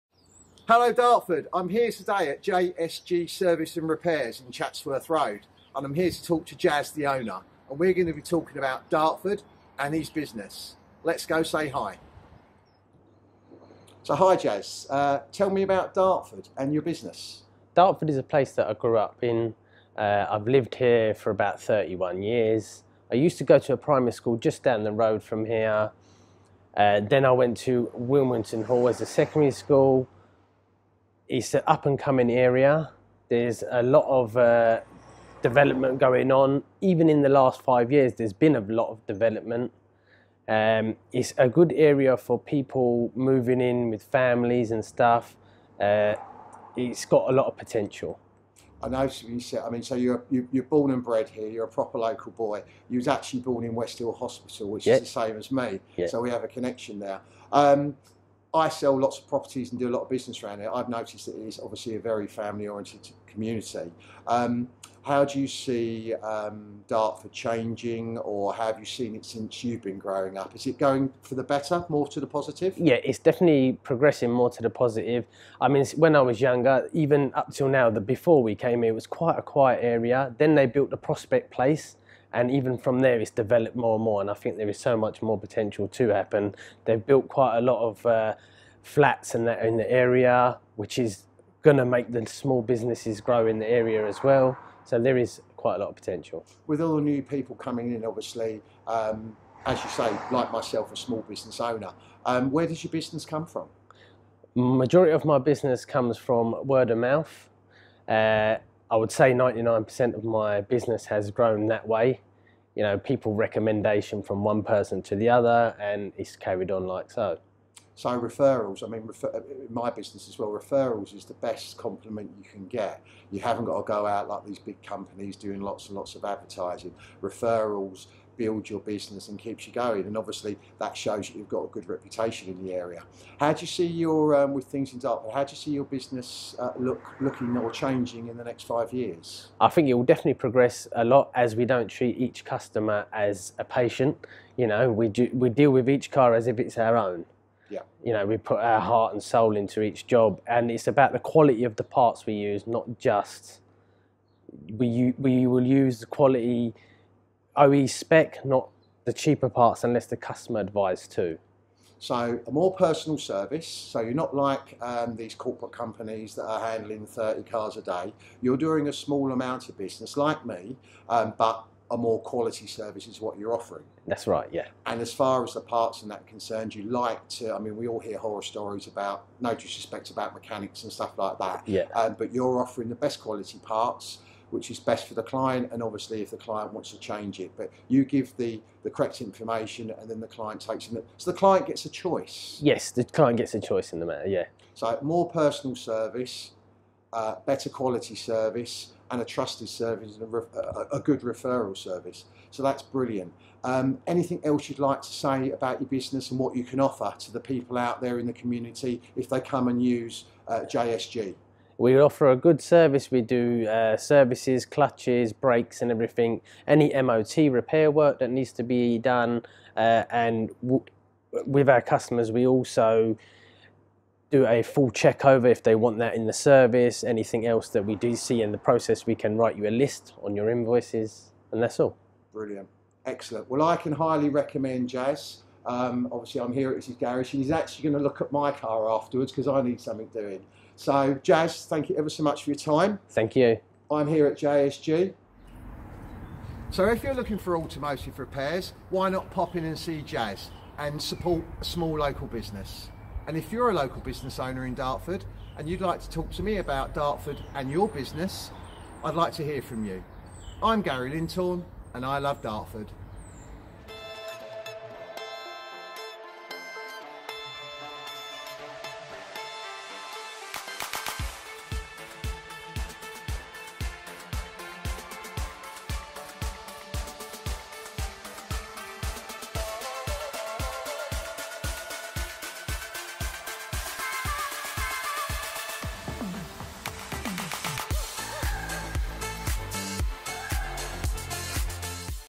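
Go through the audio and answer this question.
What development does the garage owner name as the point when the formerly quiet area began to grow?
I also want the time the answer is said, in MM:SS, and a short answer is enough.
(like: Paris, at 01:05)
Prospect Place, at 01:20.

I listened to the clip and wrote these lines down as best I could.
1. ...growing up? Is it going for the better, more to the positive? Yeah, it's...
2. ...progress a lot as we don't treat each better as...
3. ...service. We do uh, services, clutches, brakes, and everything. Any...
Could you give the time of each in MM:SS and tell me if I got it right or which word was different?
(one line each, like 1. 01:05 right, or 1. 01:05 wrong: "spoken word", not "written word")
1. 01:09 right
2. 02:20 wrong: "customer", not "better"
3. 03:32 right.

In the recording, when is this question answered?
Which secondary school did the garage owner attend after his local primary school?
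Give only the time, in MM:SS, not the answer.
00:27.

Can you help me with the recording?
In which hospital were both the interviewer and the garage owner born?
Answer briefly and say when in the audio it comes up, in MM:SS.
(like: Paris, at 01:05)
West Hill Hospital, at 00:53.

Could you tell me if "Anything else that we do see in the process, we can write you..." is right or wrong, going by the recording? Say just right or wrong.
right.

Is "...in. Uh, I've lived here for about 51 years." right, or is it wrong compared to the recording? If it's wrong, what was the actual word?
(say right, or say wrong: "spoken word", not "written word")
wrong: "31", not "51".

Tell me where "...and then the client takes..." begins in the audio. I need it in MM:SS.
03:09.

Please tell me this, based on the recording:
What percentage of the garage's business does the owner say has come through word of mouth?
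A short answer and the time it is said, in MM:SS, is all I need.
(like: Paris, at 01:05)
99%, at 01:49.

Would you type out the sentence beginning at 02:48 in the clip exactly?
You're doing a small amount of business like me, um, but a more quality service is what you're offering.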